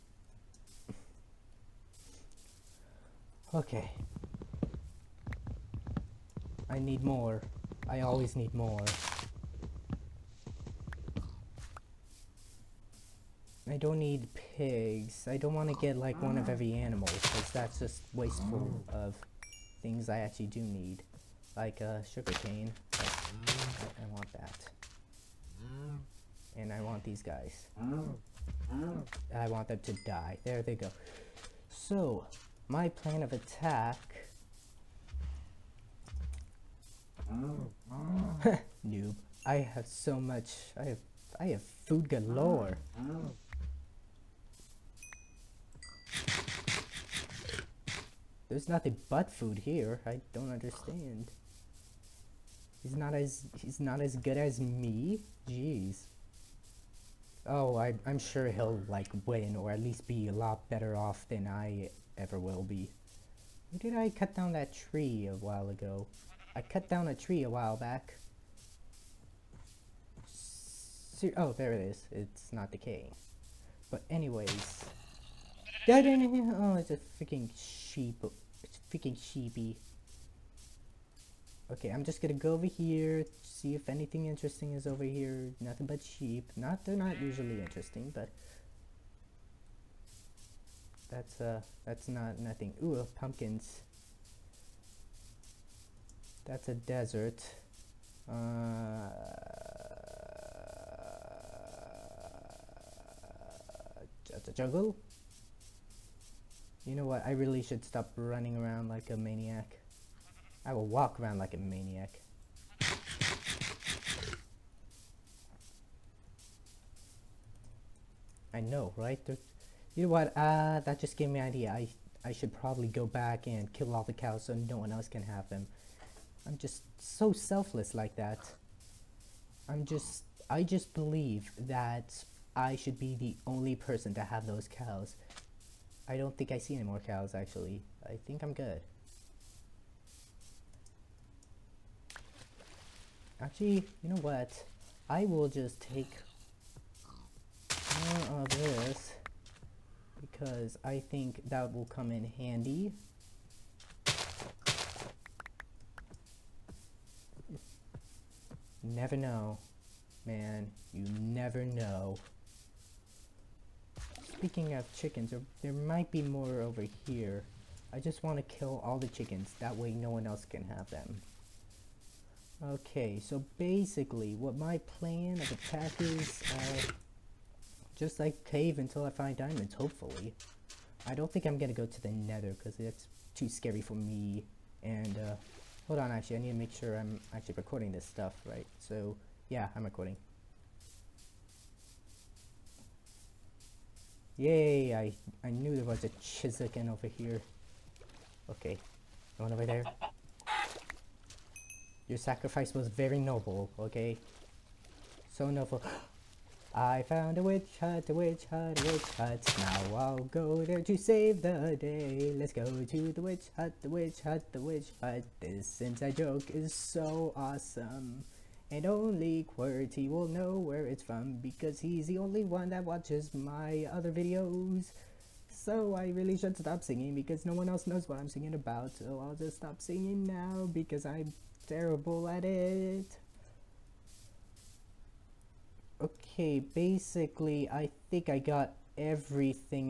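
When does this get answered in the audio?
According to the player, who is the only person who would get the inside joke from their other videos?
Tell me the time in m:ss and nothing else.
3:39.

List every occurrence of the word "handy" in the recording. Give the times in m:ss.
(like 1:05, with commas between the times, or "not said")
2:32.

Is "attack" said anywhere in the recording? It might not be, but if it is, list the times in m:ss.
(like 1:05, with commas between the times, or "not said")
0:33, 2:55.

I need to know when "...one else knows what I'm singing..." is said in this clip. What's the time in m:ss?
3:47.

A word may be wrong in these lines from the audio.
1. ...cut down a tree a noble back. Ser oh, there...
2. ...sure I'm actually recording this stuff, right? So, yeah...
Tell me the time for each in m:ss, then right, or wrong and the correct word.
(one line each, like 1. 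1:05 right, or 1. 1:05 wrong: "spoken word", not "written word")
1. 1:06 wrong: "while", not "noble"
2. 3:06 right.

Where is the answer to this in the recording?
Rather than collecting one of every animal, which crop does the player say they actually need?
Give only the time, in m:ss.
0:22.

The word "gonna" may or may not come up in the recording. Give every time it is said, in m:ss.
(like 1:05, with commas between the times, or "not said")
1:22, 3:01.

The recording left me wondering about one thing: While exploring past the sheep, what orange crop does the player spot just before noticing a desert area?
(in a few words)
Pumpkins.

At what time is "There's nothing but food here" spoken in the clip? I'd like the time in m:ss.
0:48.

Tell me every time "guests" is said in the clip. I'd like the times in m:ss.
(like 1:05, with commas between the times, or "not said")
not said.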